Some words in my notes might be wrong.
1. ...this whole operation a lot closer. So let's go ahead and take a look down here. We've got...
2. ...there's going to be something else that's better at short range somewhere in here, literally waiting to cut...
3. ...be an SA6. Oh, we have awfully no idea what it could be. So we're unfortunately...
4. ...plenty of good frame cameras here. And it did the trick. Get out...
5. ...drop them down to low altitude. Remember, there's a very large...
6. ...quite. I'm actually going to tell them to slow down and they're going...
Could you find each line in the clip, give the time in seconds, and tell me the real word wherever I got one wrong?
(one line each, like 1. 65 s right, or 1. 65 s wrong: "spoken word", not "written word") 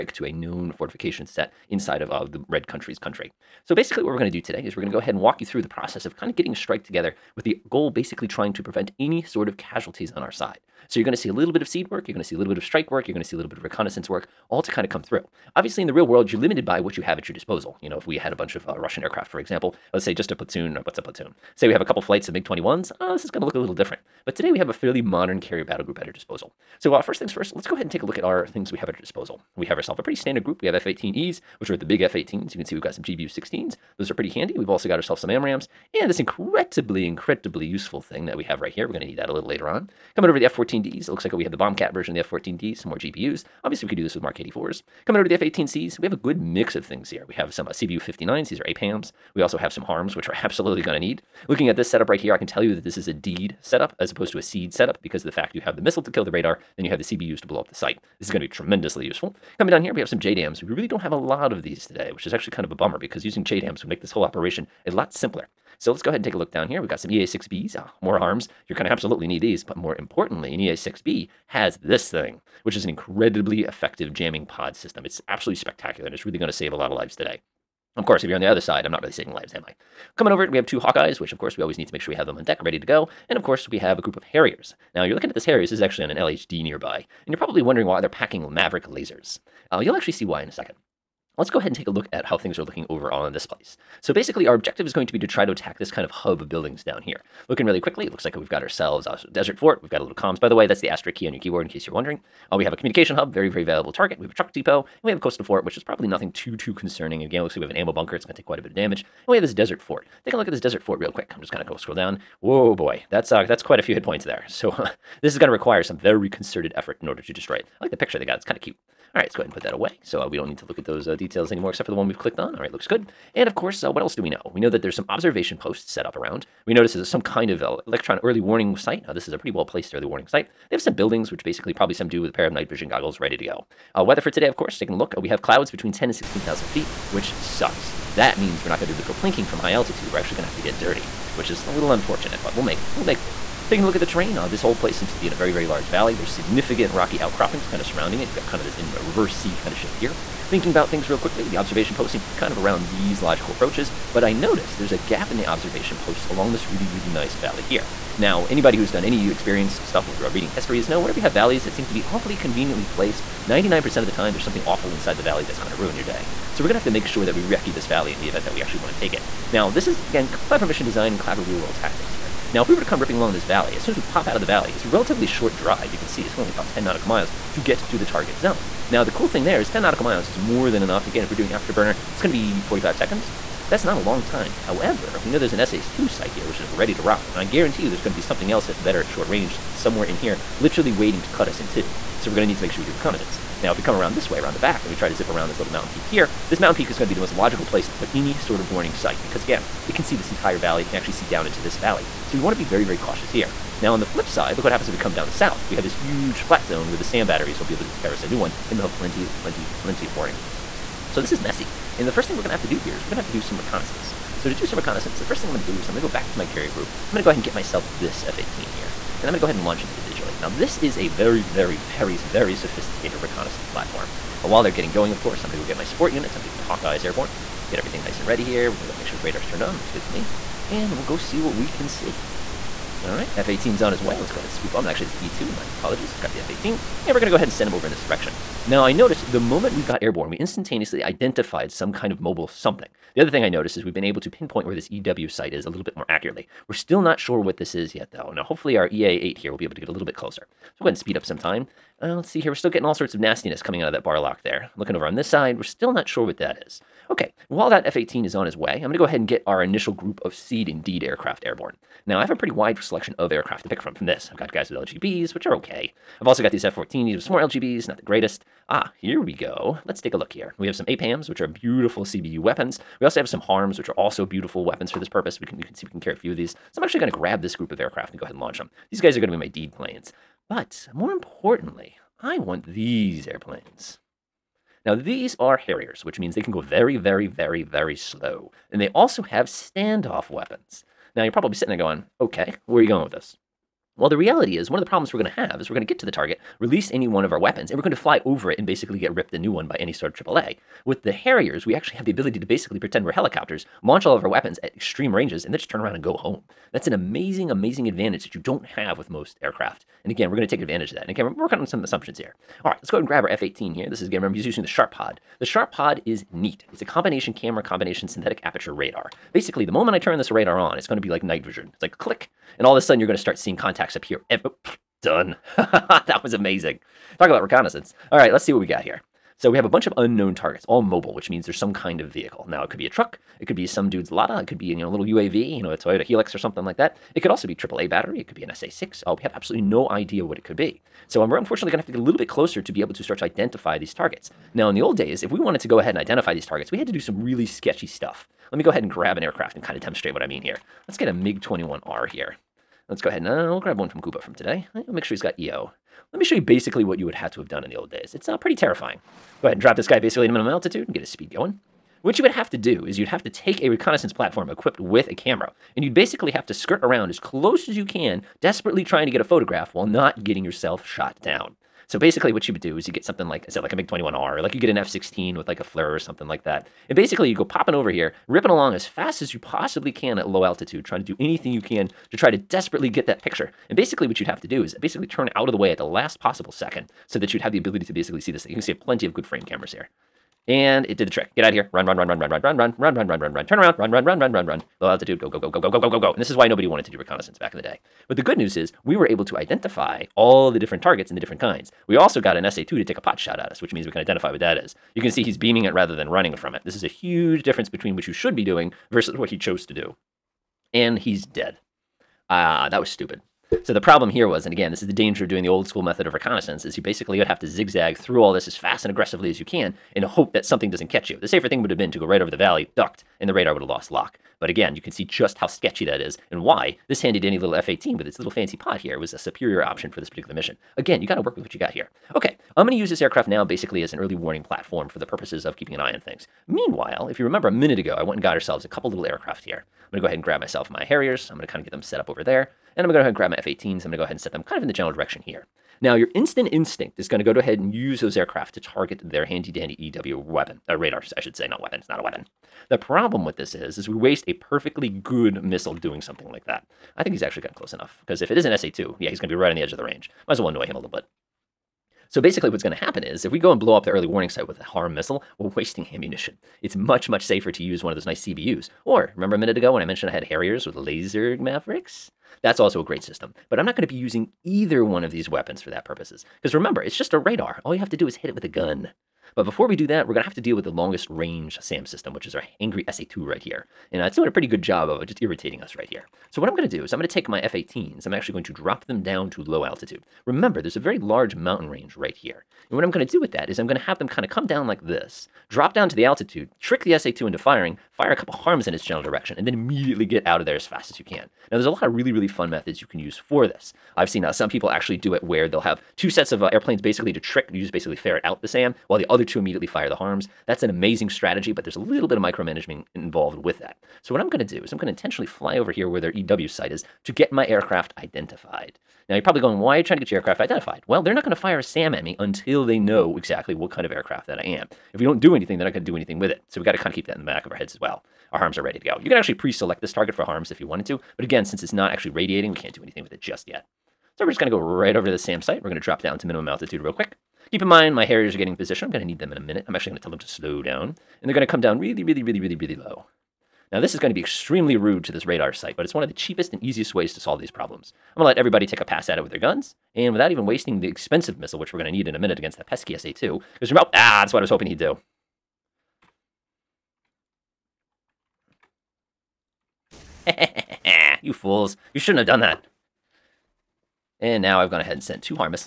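1. 64 s wrong: "simpler", not "closer"
2. 187 s right
3. 338 s wrong: "absolutely", not "awfully"
4. 388 s right
5. 488 s right
6. 539 s wrong: "minute", not "quite".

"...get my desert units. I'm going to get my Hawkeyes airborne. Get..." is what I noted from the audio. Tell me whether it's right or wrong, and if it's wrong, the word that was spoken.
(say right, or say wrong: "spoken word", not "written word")
wrong: "support", not "desert".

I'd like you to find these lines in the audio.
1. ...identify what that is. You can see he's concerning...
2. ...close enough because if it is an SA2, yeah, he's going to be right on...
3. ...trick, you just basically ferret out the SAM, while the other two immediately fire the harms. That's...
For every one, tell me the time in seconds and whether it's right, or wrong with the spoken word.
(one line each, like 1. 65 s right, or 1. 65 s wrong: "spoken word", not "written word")
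1. 403 s wrong: "beaming", not "concerning"
2. 457 s right
3. 507 s right.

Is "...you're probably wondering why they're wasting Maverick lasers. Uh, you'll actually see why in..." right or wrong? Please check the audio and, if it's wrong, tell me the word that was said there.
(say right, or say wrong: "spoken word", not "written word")
wrong: "packing", not "wasting".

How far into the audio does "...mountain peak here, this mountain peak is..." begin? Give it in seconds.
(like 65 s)
195 s.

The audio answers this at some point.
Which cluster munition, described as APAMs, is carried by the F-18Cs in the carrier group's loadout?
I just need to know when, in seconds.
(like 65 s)
47 s.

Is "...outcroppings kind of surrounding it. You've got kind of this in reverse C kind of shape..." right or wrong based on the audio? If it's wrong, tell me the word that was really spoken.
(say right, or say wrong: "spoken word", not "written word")
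right.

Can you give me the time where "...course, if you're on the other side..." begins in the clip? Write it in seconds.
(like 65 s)
78 s.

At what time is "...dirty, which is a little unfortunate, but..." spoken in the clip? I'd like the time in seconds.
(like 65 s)
140 s.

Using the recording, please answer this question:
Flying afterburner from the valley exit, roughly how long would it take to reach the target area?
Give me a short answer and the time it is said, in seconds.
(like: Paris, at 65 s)
45 seconds, at 182 s.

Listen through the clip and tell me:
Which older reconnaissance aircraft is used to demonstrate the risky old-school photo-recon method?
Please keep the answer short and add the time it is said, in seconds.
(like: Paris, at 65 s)
MiG-21R, at 351 s.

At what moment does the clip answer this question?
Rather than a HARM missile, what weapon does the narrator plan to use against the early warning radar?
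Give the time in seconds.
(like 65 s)
478 s.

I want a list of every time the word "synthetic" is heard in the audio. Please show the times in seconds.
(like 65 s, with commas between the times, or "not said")
318 s.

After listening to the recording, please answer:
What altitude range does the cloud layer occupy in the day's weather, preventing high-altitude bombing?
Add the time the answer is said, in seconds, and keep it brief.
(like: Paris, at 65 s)
10 to 16,000 feet, at 135 s.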